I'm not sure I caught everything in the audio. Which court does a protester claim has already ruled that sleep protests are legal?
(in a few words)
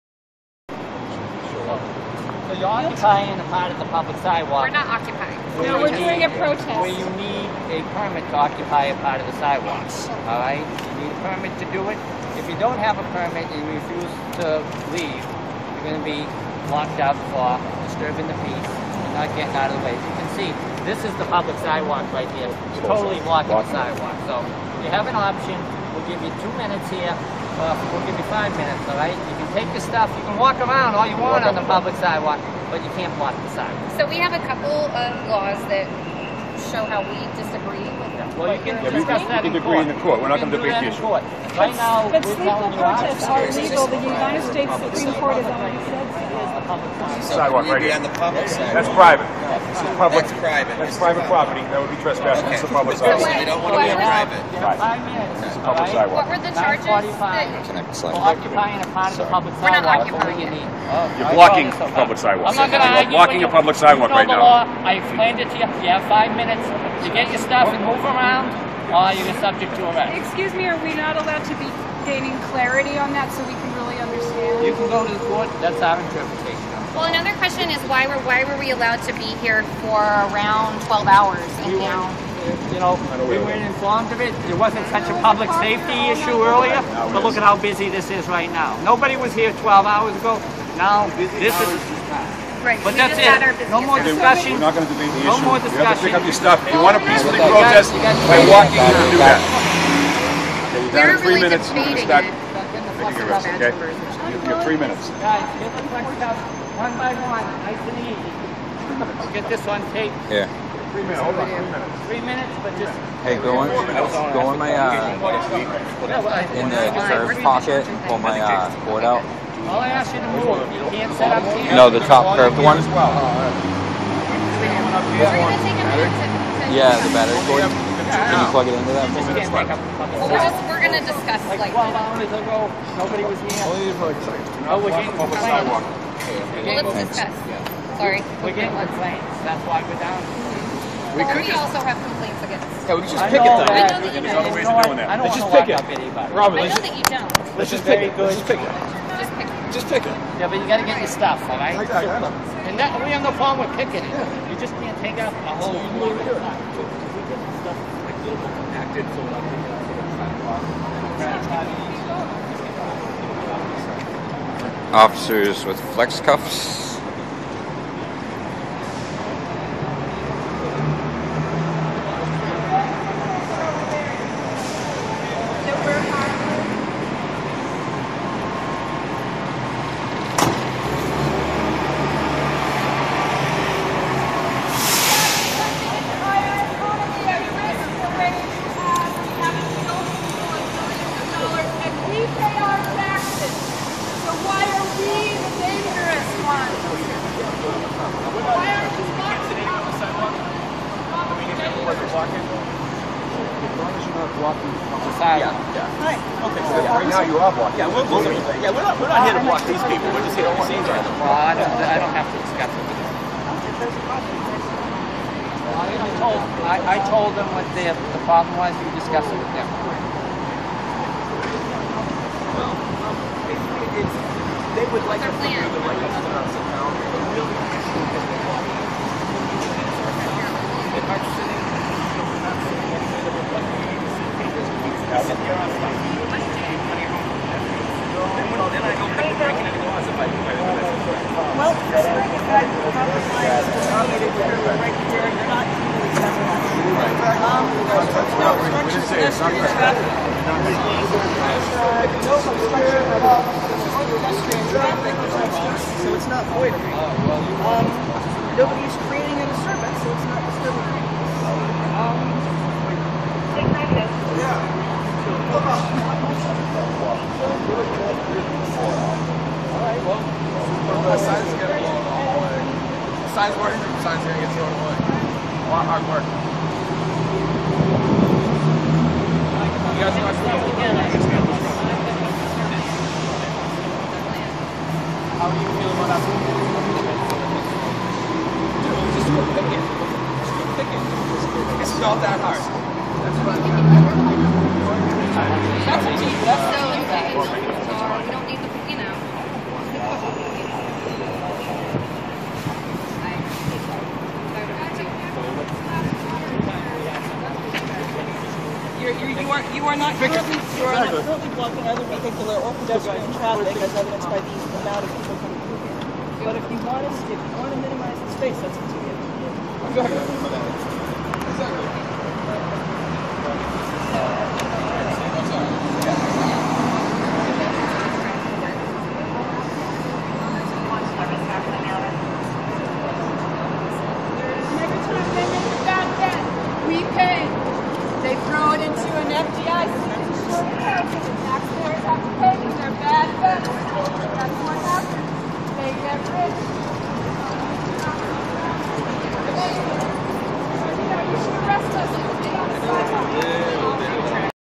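United States Supreme Court.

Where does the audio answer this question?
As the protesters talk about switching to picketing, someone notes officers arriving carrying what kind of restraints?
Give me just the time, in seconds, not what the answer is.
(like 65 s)
165 s.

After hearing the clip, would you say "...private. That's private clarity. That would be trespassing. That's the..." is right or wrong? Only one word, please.
wrong.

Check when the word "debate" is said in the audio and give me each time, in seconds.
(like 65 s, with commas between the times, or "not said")
40 s, 94 s.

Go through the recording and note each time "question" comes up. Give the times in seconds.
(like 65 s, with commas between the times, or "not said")
77 s, 105 s.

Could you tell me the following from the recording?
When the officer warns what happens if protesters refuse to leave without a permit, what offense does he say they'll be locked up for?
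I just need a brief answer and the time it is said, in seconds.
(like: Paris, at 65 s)
Disturbing the peace, at 17 s.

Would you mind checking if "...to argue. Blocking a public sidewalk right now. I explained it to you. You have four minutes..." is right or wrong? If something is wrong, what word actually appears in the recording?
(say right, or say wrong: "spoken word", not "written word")
wrong: "five", not "four".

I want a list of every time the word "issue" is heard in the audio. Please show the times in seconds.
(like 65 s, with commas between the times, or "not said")
40 s, 86 s, 95 s.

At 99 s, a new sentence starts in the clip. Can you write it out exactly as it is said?
Okay, you're down to three really minutes.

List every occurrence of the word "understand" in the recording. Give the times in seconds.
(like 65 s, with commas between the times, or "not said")
73 s.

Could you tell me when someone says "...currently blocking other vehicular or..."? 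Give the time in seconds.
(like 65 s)
311 s.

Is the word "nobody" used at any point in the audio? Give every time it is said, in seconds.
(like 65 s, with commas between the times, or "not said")
88 s, 132 s.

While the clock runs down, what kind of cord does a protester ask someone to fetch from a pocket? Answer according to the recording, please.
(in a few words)
Battery cord.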